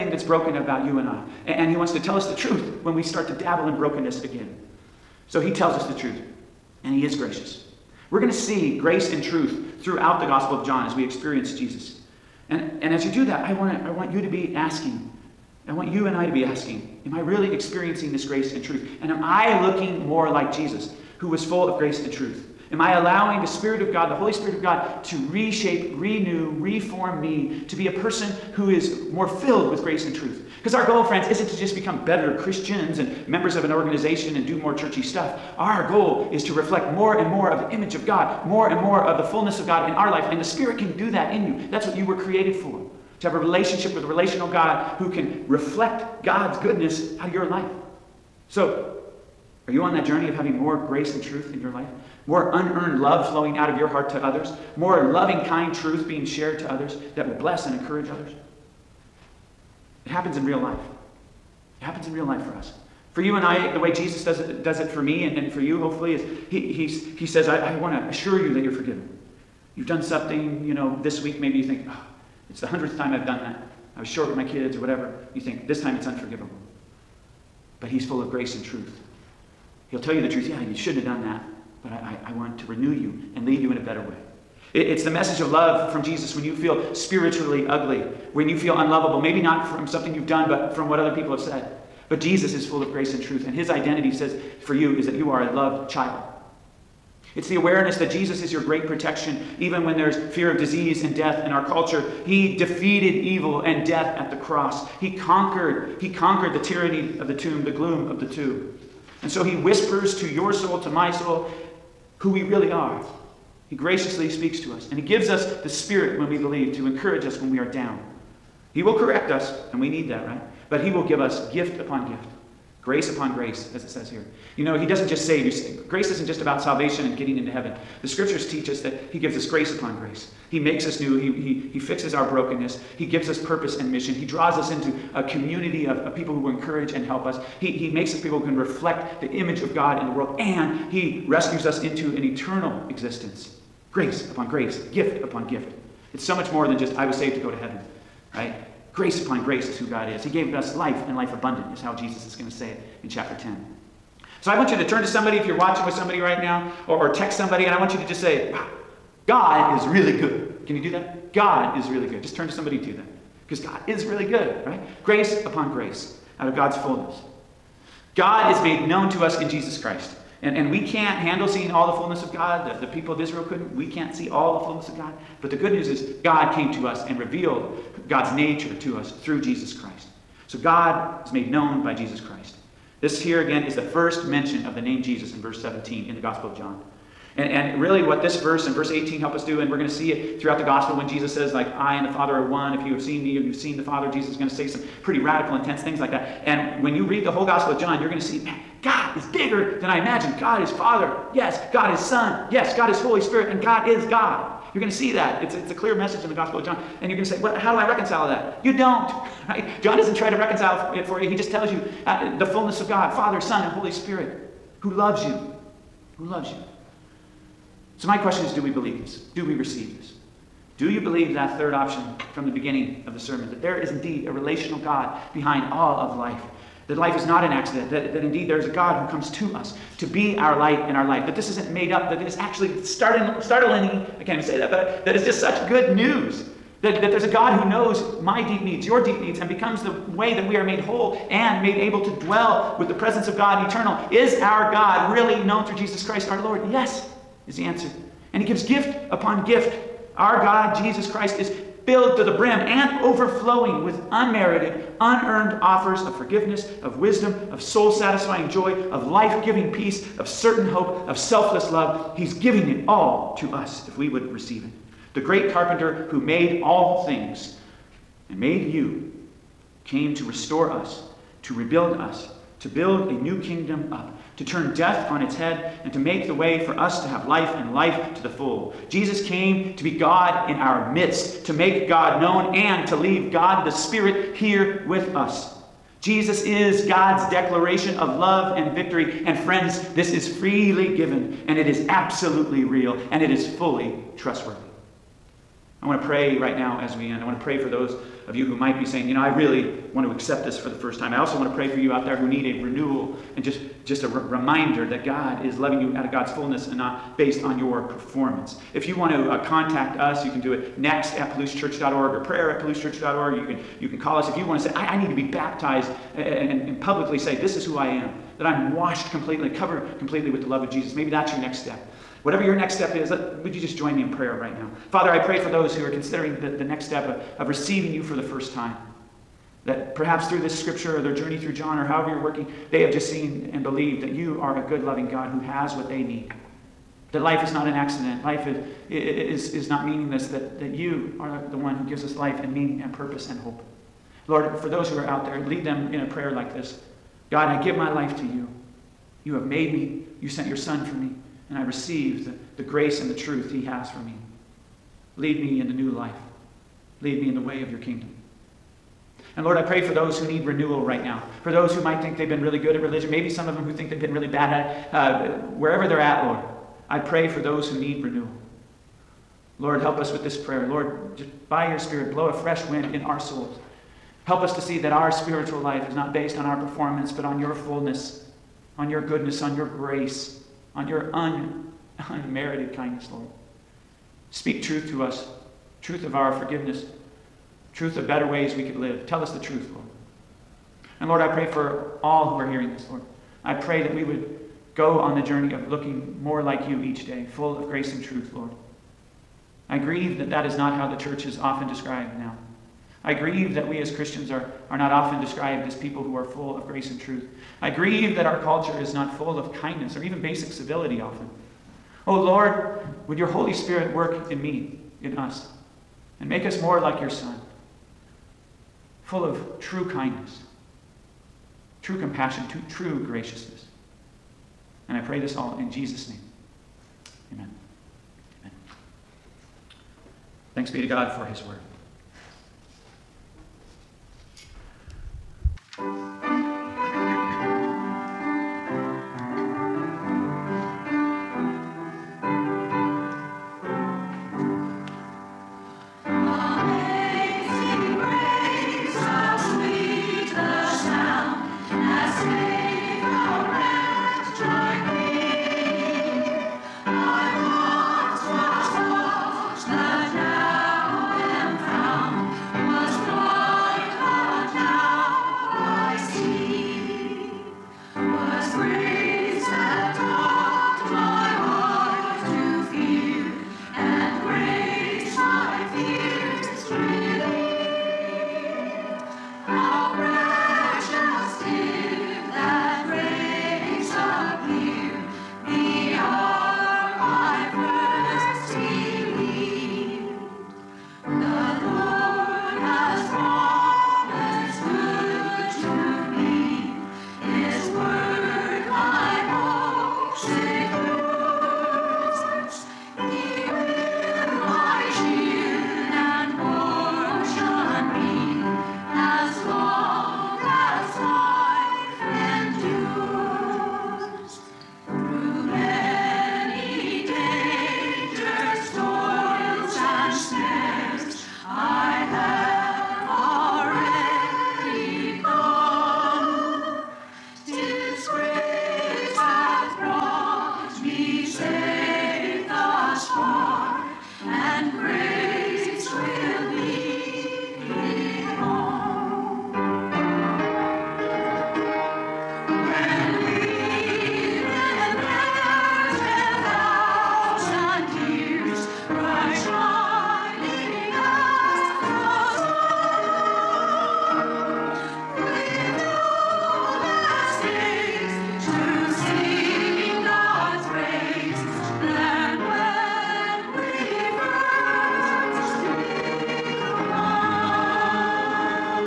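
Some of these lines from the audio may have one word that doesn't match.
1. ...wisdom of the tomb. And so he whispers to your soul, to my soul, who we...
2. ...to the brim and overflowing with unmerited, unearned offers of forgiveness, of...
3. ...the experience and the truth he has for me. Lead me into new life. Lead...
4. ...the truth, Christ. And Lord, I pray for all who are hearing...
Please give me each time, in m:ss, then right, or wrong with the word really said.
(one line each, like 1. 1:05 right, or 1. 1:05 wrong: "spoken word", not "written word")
1. 1:47 wrong: "gloom", not "wisdom"
2. 4:12 right
3. 5:52 wrong: "grace", not "experience"
4. 6:29 wrong: "Lord", not "Christ".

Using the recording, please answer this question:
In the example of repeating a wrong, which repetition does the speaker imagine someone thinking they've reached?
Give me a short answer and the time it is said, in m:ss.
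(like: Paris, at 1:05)
100th, at 1:12.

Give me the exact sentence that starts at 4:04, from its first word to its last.
Is our God really known through Jesus Christ our Lord?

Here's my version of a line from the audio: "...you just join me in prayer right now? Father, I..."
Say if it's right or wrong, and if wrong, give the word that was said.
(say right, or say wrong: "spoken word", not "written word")
right.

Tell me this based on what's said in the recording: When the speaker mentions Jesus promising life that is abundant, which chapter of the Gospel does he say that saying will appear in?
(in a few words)
Chapter 10.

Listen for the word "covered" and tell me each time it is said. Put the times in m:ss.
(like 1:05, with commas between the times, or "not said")
5:19.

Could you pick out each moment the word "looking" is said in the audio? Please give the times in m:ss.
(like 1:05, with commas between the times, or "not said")
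0:19, 6:35.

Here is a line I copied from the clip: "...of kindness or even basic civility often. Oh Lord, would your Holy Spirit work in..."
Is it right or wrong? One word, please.
right.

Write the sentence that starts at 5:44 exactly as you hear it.
Lord, for those who are out there, lead them in a prayer like this God, I give my life to you.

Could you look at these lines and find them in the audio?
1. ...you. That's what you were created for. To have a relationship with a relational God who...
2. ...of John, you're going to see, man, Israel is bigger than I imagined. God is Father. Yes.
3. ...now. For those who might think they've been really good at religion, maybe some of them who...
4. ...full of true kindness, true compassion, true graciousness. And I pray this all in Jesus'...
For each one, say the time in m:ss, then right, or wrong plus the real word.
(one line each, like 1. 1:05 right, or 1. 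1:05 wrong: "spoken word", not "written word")
1. 0:41 right
2. 3:17 wrong: "God", not "Israel"
3. 6:01 right
4. 6:59 right.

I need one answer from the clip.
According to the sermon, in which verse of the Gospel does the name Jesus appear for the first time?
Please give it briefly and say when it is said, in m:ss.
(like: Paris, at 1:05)
Verse 17, at 3:05.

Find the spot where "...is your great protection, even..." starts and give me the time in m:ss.
1:38.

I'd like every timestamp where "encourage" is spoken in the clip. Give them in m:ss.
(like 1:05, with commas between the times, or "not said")
0:57, 1:56, 2:16.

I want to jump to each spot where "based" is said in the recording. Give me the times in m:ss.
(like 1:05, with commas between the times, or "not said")
5:07, 6:16.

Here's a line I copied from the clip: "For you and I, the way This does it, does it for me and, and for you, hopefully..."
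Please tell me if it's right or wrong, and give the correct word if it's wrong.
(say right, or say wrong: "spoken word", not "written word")
wrong: "Jesus", not "This".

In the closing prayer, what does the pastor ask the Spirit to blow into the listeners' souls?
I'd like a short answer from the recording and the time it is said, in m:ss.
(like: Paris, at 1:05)
A fresh wind, at 6:12.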